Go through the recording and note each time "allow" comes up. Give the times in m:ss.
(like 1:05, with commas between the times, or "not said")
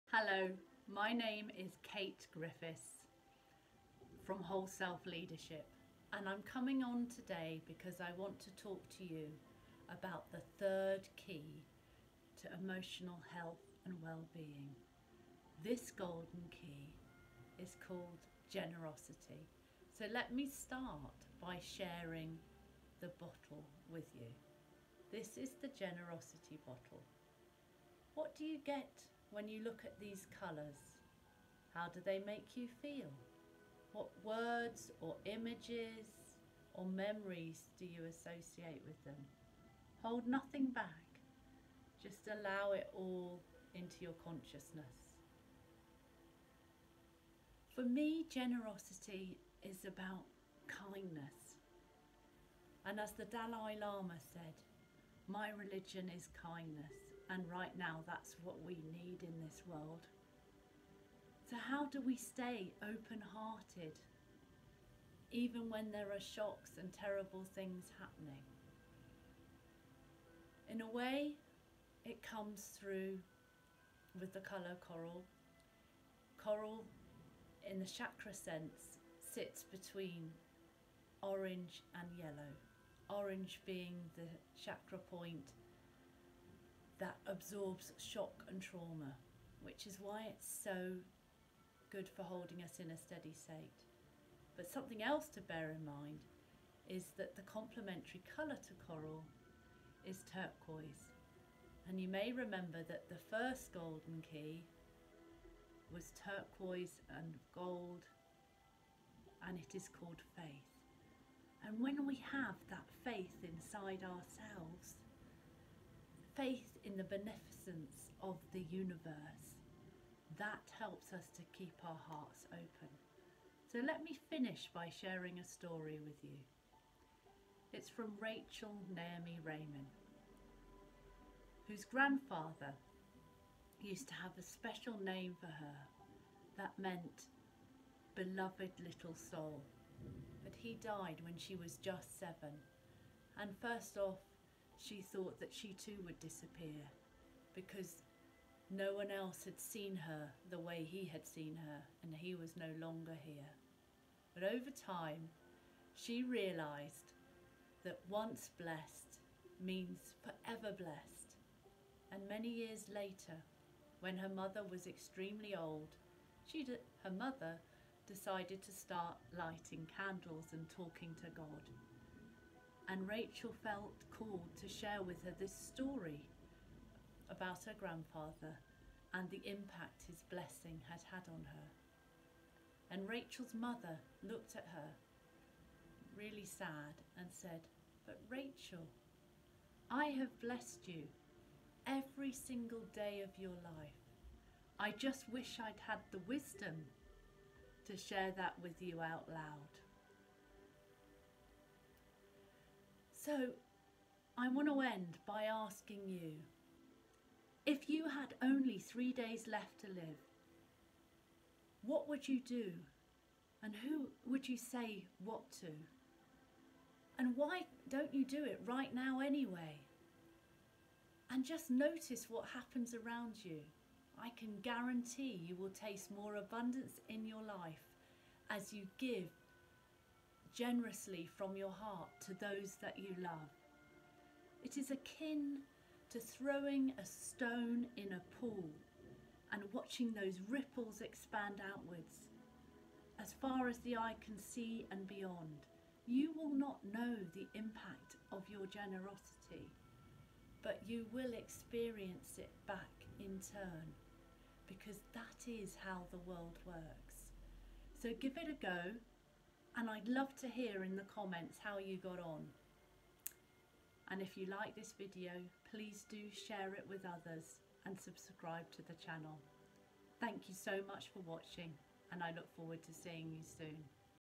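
0:42.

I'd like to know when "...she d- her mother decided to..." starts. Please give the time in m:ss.
2:46.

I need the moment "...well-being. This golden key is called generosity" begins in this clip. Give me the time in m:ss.
0:14.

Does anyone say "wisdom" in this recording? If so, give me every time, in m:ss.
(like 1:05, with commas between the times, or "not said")
3:16.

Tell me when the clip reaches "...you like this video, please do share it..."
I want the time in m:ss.
4:24.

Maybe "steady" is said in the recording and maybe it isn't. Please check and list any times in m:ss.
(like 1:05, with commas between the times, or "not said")
1:32.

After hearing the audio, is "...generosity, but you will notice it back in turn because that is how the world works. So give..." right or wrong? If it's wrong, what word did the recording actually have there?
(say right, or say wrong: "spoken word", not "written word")
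wrong: "experience", not "notice".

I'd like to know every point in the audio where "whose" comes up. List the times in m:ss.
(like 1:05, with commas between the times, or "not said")
2:11.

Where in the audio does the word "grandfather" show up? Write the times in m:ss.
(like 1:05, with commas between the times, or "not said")
2:11, 2:57.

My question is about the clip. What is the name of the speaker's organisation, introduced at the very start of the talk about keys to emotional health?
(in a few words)
Whole Self Leadership.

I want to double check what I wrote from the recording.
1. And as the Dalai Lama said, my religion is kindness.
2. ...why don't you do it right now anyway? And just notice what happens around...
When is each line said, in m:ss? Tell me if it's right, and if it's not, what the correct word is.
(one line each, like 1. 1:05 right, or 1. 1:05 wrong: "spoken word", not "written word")
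1. 0:52 right
2. 3:37 right.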